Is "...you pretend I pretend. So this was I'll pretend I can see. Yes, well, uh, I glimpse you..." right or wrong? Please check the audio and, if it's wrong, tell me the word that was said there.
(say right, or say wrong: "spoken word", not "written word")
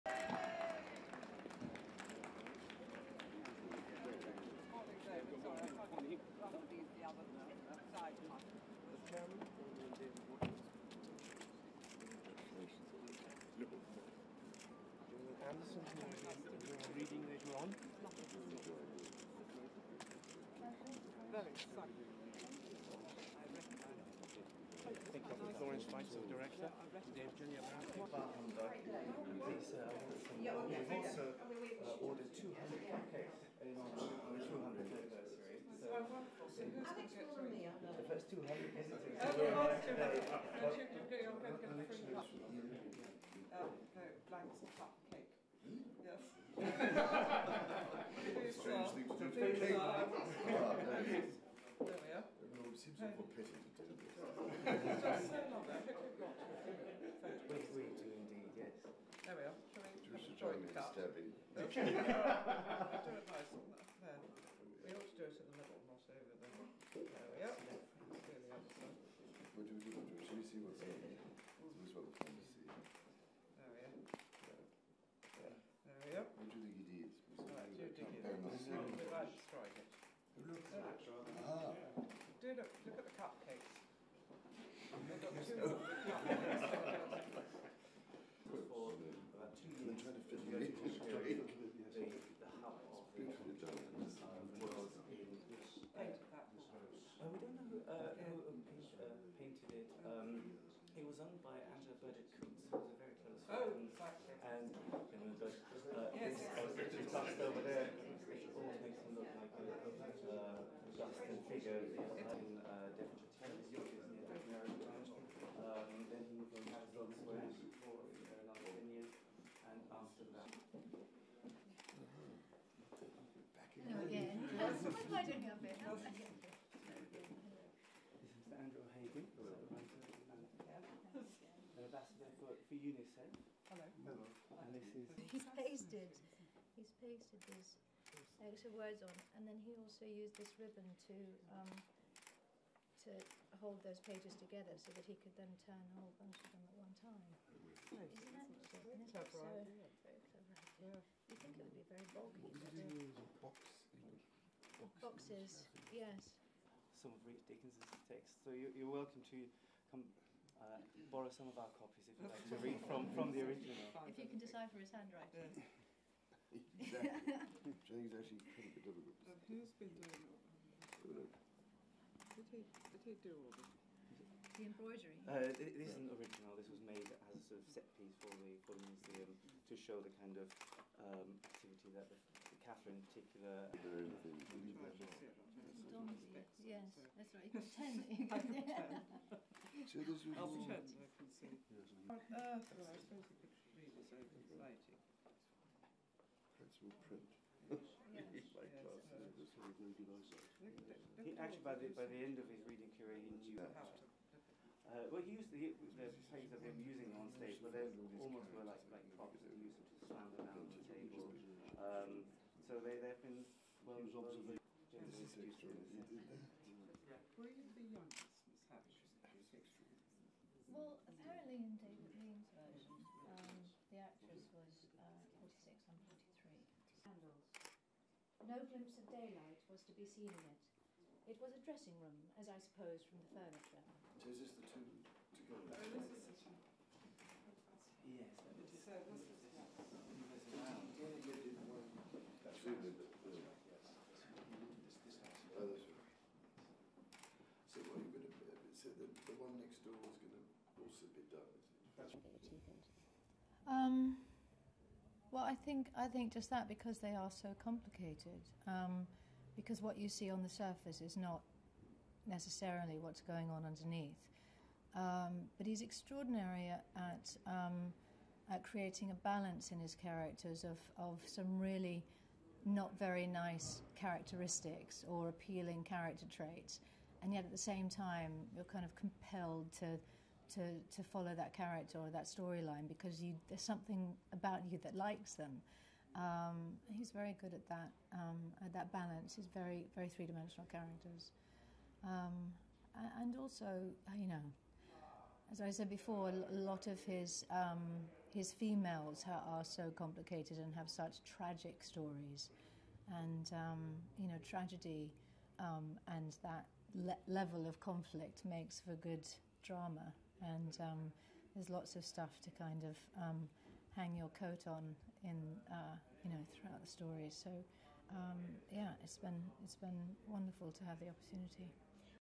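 wrong: "suppose", not "glimpse".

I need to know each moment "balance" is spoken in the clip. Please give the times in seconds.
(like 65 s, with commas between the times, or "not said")
269 s, 288 s.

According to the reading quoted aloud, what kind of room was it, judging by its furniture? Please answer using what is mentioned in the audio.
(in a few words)
dressing room.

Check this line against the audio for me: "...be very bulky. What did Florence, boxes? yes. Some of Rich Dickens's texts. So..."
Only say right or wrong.
wrong.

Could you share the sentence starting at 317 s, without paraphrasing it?
So um, yeah, it's been it's been wonderful to have the opportunity.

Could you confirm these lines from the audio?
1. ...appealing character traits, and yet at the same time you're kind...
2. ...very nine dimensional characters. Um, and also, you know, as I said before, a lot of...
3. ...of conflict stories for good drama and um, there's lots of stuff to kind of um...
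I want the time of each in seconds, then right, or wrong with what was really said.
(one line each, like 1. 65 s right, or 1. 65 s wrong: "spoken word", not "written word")
1. 275 s right
2. 289 s wrong: "three", not "nine"
3. 307 s wrong: "makes", not "stories".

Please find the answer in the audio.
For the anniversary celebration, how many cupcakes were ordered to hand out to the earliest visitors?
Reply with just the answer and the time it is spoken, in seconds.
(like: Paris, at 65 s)
200, at 32 s.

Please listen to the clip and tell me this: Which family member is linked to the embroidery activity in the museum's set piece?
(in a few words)
Catherine.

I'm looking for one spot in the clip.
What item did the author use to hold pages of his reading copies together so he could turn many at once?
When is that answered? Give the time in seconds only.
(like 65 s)
140 s.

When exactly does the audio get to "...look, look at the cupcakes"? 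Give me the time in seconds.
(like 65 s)
82 s.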